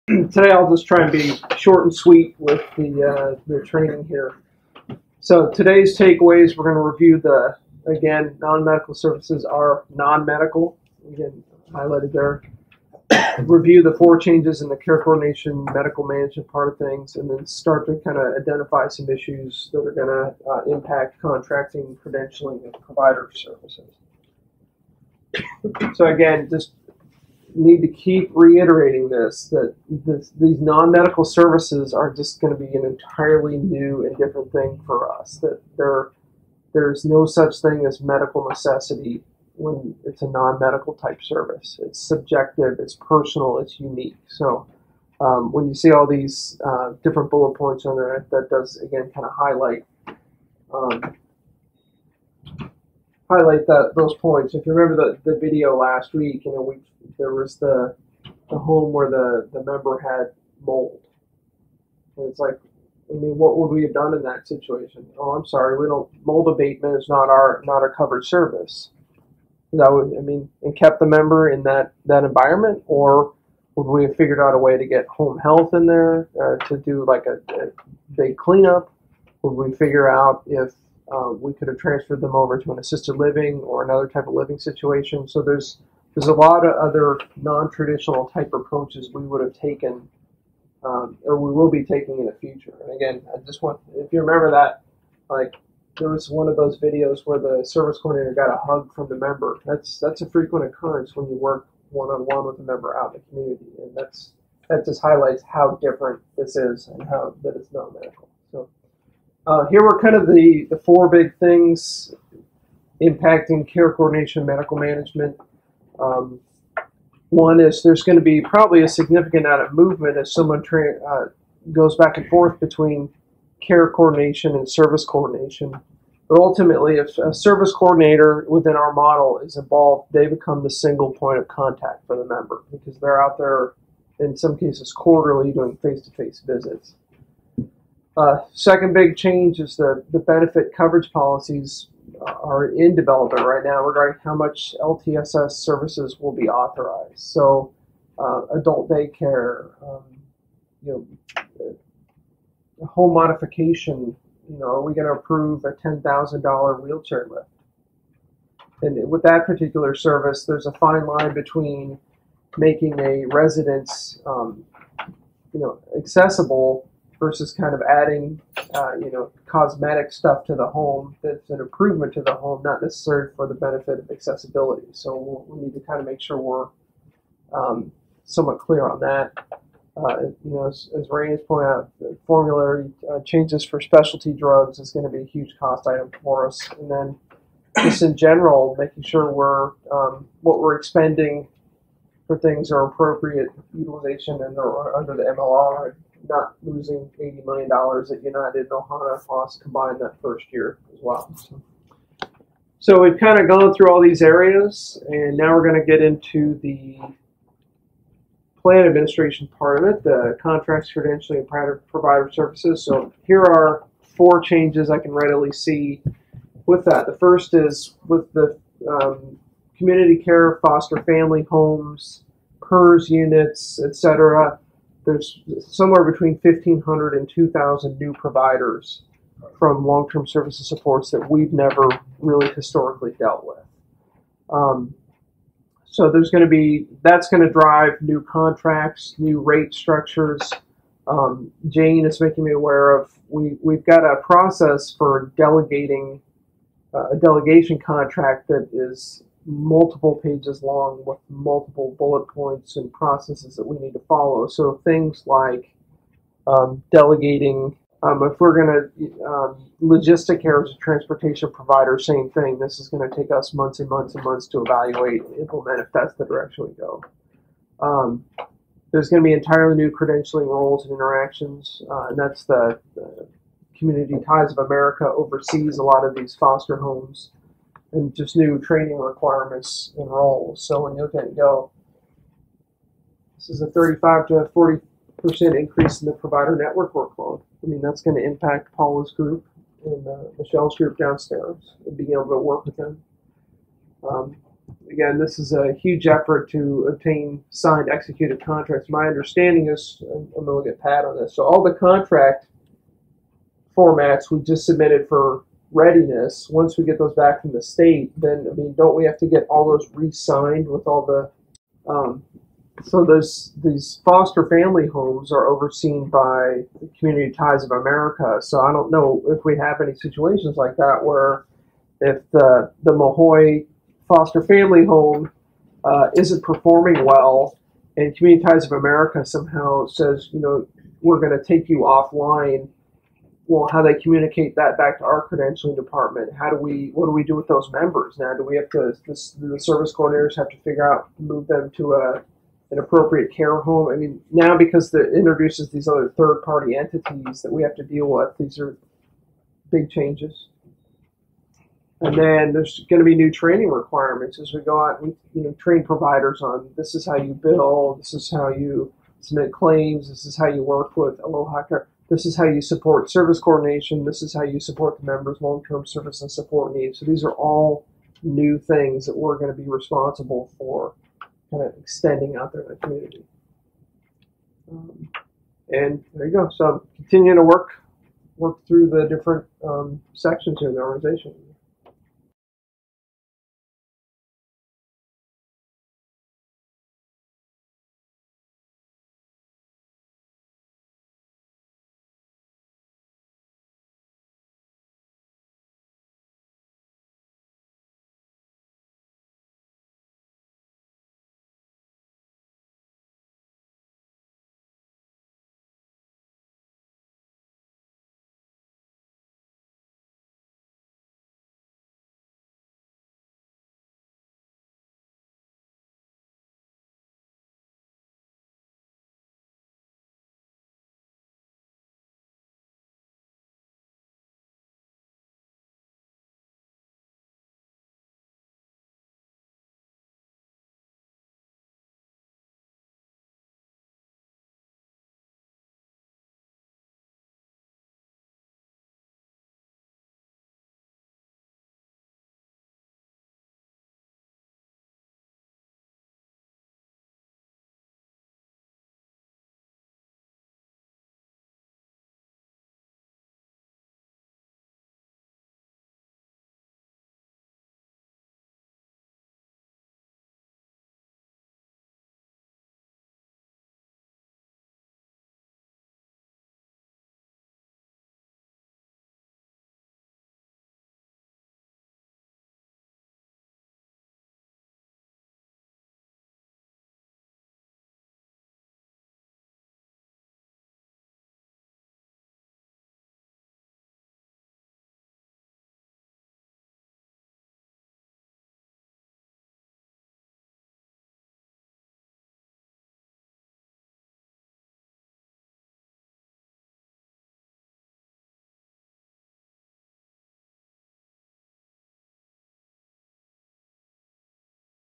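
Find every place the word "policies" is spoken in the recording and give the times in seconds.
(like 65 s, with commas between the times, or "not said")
141 s.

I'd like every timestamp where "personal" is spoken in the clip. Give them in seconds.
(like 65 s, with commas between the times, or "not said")
42 s.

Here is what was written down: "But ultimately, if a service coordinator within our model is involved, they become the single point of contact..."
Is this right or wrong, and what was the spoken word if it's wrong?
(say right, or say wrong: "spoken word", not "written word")
right.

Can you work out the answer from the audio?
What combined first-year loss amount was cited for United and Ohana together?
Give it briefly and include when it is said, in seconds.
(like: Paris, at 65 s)
80 million dollars, at 197 s.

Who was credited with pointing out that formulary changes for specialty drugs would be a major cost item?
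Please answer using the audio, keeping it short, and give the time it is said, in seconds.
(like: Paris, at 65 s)
Rain, at 181 s.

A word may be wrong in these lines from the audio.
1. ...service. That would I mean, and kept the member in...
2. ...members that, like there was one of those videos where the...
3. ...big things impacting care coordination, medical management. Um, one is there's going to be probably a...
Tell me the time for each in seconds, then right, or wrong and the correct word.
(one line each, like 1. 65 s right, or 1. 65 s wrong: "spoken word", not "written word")
1. 68 s right
2. 94 s wrong: "remember", not "members"
3. 111 s right.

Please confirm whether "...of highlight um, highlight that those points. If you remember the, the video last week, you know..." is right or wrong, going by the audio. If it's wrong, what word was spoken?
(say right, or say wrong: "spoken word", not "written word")
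right.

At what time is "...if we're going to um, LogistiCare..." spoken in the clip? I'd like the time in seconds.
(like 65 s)
258 s.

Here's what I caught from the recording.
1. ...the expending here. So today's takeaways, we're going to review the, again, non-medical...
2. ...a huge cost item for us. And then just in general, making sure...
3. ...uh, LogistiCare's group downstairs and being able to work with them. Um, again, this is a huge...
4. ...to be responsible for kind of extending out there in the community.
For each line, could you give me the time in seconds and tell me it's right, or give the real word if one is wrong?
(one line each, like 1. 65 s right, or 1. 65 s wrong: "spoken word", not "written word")
1. 3 s wrong: "training", not "expending"
2. 185 s right
3. 290 s wrong: "Michelle", not "LogistiCare"
4. 369 s right.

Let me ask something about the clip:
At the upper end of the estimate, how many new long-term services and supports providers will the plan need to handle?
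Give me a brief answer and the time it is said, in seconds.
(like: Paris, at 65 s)
2,000, at 227 s.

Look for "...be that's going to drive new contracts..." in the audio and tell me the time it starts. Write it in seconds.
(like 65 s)
236 s.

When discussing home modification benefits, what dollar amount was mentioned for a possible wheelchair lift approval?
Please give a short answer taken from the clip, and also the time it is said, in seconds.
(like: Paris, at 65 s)
$10,000, at 155 s.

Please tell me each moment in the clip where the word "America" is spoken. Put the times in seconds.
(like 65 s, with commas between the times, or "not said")
274 s, 317 s, 328 s.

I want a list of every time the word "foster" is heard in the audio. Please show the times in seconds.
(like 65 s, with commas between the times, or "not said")
220 s, 276 s, 314 s, 324 s.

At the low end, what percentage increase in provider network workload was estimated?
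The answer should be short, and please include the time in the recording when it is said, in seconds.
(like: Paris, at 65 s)
35 percent, at 283 s.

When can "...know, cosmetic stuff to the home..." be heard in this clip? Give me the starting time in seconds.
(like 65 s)
169 s.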